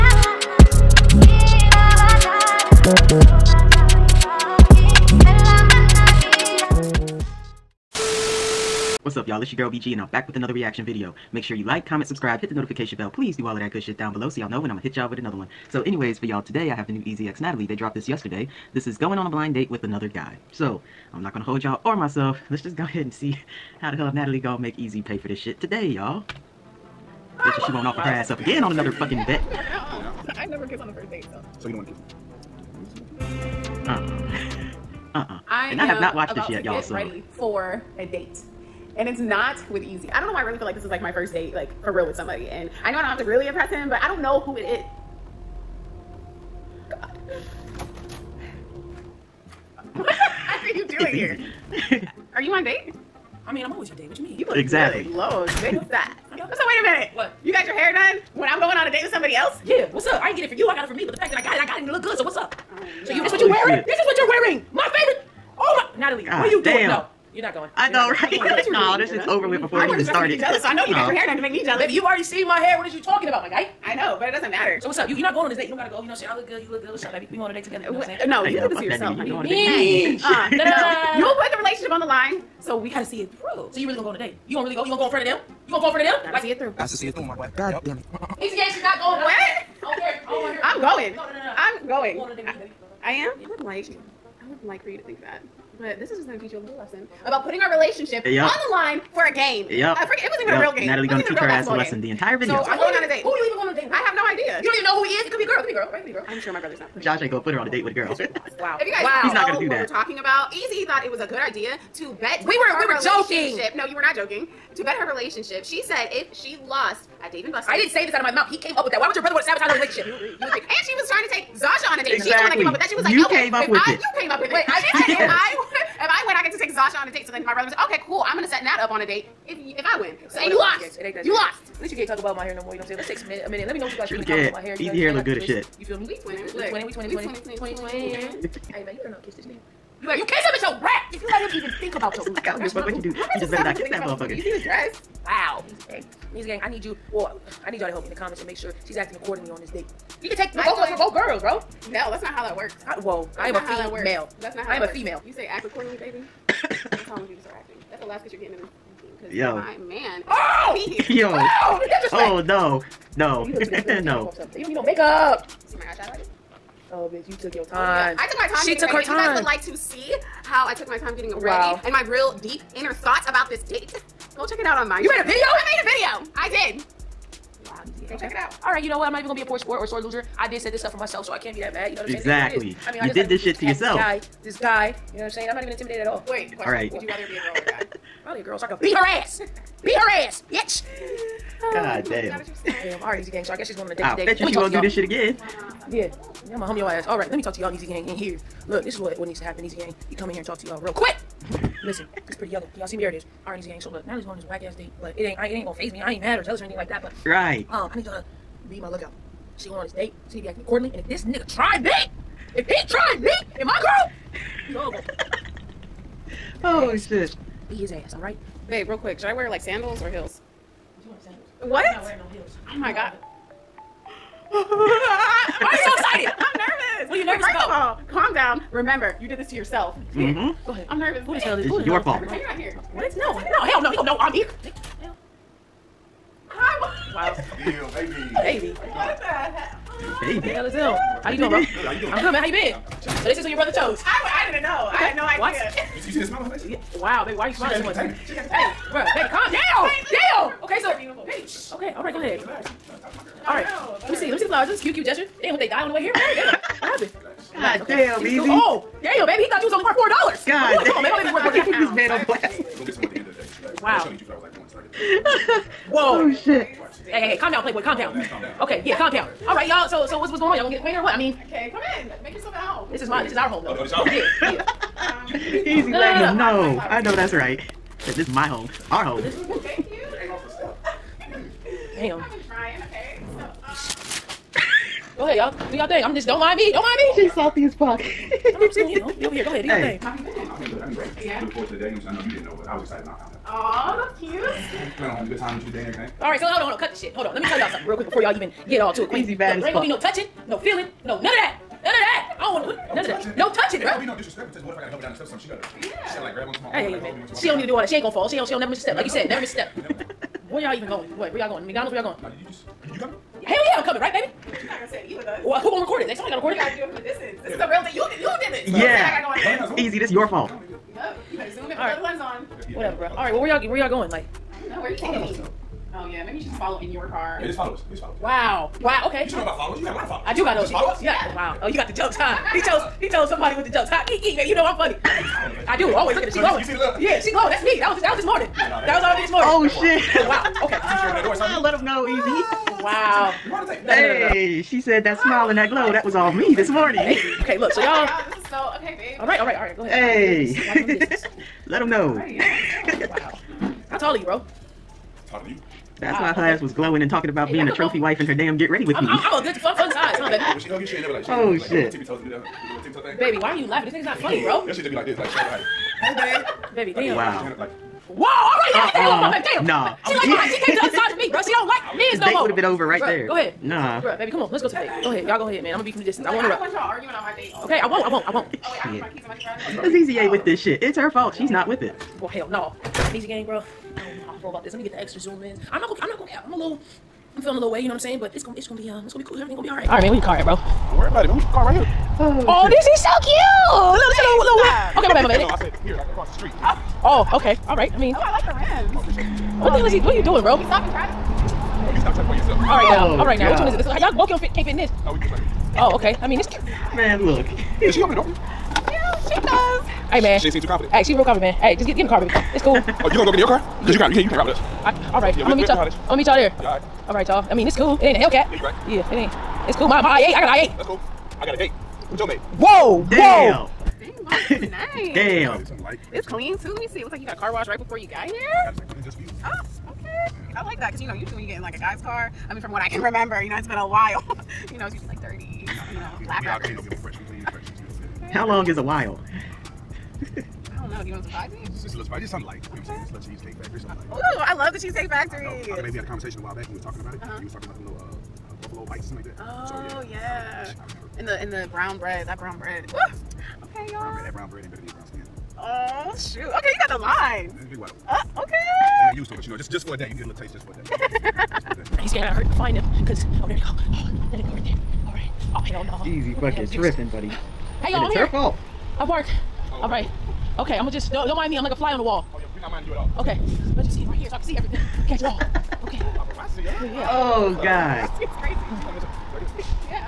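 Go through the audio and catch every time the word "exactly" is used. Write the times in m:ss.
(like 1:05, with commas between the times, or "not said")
0:54, 2:02, 3:02.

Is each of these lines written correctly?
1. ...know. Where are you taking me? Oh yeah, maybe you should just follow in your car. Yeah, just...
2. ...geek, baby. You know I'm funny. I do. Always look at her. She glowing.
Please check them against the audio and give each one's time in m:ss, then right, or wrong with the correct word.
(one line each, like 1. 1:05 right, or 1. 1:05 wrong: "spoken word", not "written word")
1. 5:24 right
2. 5:34 right.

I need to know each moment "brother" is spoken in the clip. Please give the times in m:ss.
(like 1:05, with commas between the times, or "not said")
1:46, 1:59, 2:07, 4:03.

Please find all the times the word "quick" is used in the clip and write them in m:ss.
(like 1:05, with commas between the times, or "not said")
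3:20, 3:38, 4:57.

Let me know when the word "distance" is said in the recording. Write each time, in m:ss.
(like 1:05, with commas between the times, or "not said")
5:17, 6:16.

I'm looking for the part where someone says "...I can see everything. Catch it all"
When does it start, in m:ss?
7:54.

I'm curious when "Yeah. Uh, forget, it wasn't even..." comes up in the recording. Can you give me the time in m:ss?
1:39.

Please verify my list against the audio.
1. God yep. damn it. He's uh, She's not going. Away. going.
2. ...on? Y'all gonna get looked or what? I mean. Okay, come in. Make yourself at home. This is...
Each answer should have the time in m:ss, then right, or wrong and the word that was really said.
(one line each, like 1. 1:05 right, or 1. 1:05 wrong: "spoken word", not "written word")
1. 1:27 right
2. 4:30 wrong: "acquainted", not "looked".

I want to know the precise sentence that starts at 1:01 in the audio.
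But the fact that I got it, I got it and it looked good, so what's up?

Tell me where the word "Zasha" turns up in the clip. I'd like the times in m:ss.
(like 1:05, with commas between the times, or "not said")
2:01, 2:06.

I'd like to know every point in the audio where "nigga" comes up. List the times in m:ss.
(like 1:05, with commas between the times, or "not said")
2:19, 3:31, 6:03.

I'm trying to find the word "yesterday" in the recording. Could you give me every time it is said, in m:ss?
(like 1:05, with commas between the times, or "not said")
0:18.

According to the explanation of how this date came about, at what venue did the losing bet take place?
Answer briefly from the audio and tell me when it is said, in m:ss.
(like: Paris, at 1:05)
Dave and Buster's, at 1:57.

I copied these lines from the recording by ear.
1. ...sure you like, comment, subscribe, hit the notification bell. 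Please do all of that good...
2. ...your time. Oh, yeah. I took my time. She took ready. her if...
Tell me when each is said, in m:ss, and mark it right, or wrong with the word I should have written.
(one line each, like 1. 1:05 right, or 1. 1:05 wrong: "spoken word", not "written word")
1. 0:11 right
2. 2:47 right.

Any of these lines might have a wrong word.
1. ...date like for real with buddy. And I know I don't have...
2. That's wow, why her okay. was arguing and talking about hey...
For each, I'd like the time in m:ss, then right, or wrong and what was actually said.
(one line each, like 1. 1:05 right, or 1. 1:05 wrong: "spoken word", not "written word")
1. 0:41 wrong: "somebody", not "buddy"
2. 5:55 wrong: "glowing", not "arguing".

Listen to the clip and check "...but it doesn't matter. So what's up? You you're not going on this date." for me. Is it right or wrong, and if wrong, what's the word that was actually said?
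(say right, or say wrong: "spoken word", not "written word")
right.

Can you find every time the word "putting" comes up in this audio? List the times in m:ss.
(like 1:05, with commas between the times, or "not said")
1:37.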